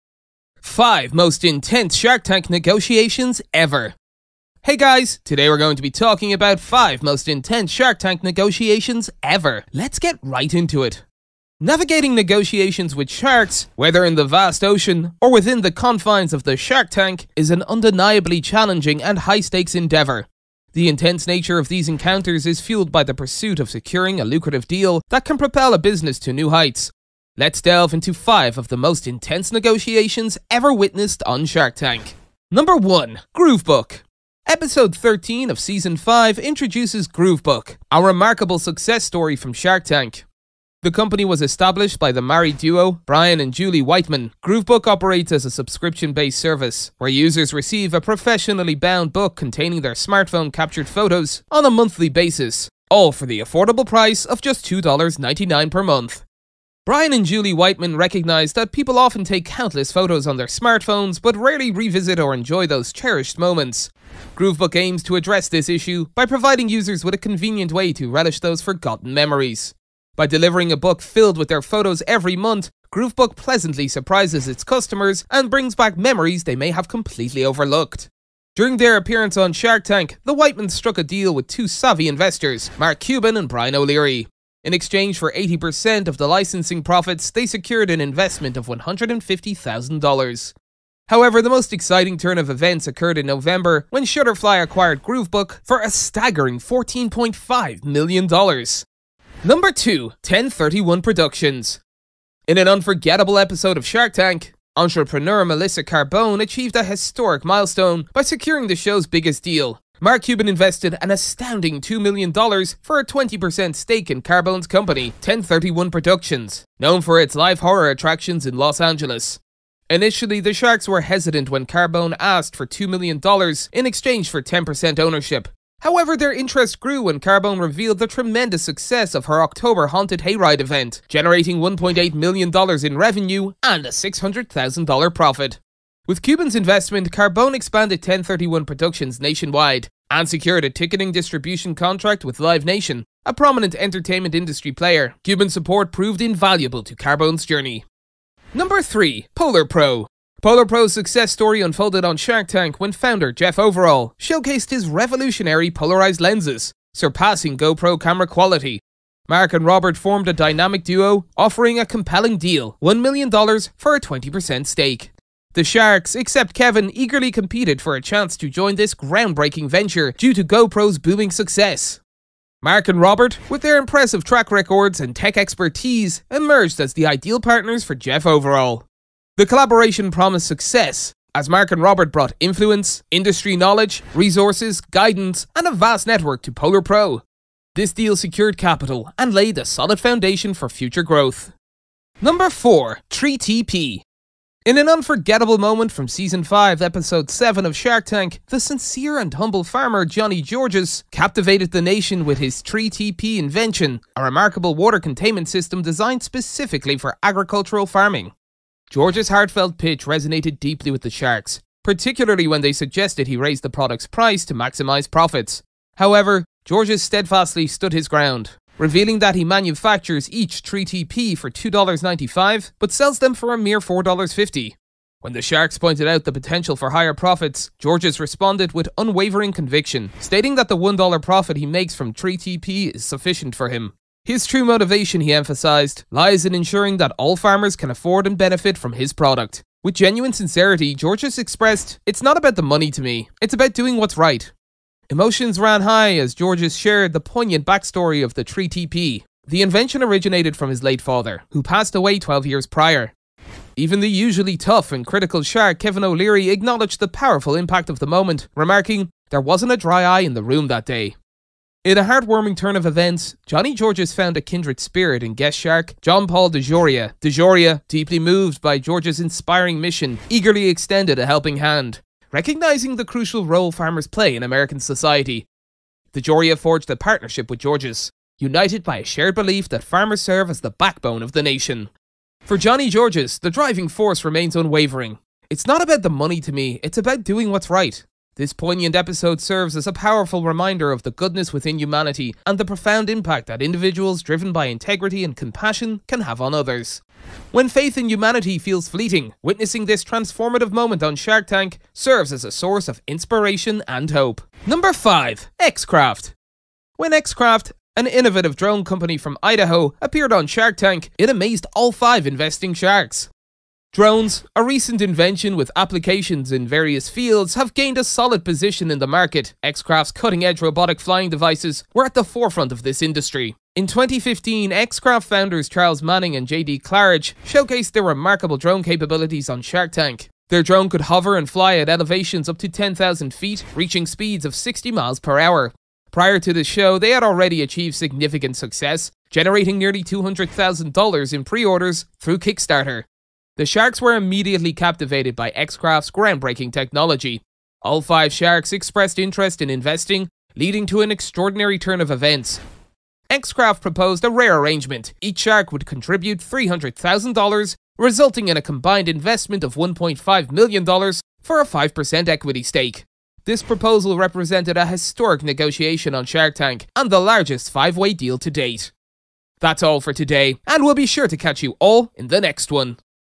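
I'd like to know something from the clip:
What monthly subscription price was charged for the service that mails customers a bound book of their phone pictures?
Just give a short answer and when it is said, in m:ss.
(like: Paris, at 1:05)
$2.99, at 0:54.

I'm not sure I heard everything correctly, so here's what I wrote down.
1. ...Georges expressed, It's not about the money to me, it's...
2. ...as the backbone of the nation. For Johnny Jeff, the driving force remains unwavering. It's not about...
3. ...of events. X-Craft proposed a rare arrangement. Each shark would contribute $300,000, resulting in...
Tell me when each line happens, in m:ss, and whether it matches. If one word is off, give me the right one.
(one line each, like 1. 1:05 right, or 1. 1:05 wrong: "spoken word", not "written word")
1. 4:00 right
2. 4:40 wrong: "Georges", not "Jeff"
3. 5:52 right.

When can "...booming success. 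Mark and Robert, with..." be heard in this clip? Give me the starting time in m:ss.
2:50.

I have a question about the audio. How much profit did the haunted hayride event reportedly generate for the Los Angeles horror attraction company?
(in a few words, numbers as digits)
$600,000.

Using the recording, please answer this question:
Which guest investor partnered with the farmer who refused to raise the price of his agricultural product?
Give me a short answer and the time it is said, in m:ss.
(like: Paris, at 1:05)
John Paul DeJoria, at 4:26.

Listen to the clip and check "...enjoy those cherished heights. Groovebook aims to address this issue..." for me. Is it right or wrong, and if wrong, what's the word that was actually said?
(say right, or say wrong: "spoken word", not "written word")
wrong: "moments", not "heights".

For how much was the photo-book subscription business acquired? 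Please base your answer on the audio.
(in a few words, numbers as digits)
$14.5 million.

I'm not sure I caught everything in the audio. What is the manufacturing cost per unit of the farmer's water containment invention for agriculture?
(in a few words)
$2.95.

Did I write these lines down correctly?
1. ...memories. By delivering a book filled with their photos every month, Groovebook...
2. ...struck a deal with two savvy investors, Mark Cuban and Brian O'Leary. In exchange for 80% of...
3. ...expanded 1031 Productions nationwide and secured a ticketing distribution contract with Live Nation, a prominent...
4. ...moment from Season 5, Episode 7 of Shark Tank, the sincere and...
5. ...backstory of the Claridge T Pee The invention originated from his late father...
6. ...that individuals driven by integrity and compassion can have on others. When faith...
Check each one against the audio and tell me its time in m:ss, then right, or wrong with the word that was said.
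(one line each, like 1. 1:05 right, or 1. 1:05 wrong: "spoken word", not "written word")
1. 1:09 right
2. 1:20 right
3. 2:17 right
4. 3:15 right
5. 4:07 wrong: "Tree", not "Claridge"
6. 4:53 right.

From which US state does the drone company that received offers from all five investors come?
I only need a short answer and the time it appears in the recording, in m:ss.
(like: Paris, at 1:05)
Idaho, at 5:09.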